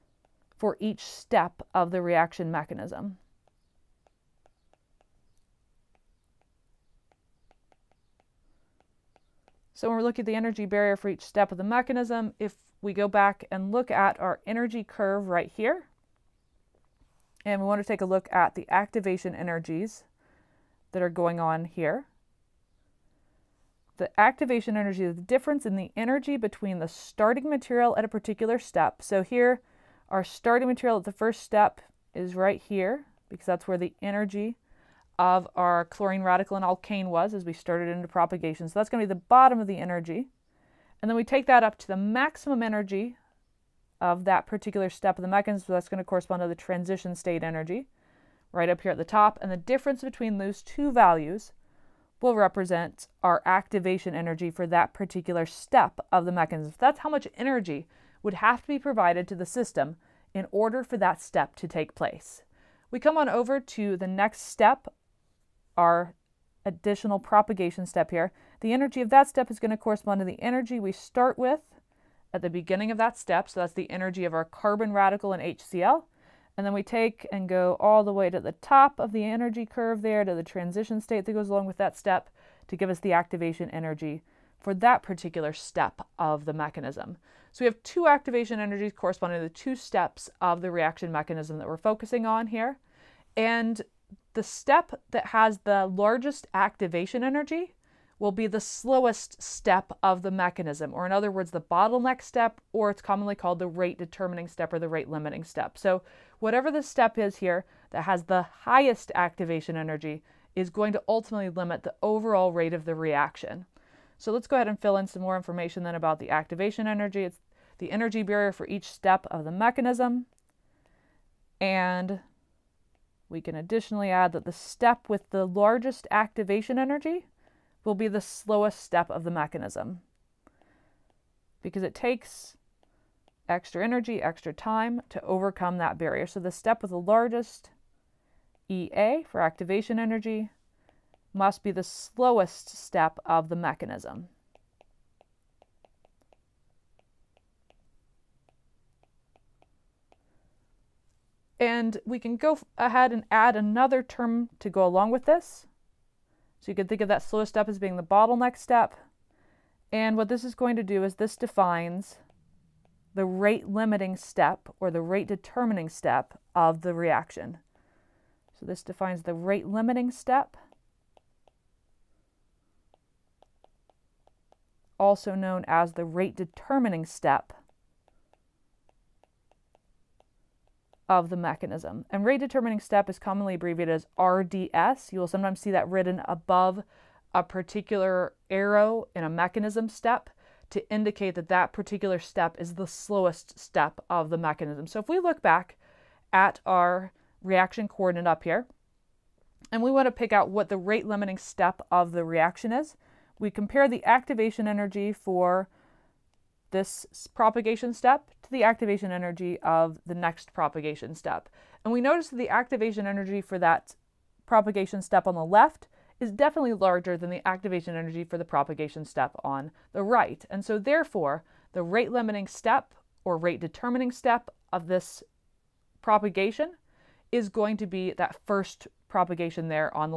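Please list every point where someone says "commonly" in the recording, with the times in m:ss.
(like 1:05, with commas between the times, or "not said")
1:43, 3:03.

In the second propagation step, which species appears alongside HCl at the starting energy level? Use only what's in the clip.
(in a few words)
Carbon radical.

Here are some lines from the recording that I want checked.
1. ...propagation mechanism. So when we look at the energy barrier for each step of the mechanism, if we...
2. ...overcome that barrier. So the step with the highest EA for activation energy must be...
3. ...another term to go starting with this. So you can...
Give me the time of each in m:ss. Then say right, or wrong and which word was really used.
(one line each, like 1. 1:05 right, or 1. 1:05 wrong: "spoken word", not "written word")
1. 0:02 wrong: "reaction", not "propagation"
2. 2:15 wrong: "largest", not "highest"
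3. 2:33 wrong: "along", not "starting".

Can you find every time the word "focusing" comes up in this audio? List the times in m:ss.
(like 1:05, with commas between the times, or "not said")
1:31.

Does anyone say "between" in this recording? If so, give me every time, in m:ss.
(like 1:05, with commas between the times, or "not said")
0:26, 0:50.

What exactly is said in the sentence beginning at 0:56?
That's how much energy would have to be provided to the system in order for that step to take place.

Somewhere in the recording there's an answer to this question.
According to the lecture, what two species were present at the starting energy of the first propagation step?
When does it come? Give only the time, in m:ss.
0:35.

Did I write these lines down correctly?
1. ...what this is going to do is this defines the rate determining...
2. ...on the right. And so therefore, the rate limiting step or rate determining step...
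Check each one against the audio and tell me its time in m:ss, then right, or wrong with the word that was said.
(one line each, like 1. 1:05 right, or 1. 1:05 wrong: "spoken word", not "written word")
1. 2:40 wrong: "limiting", not "determining"
2. 3:39 right.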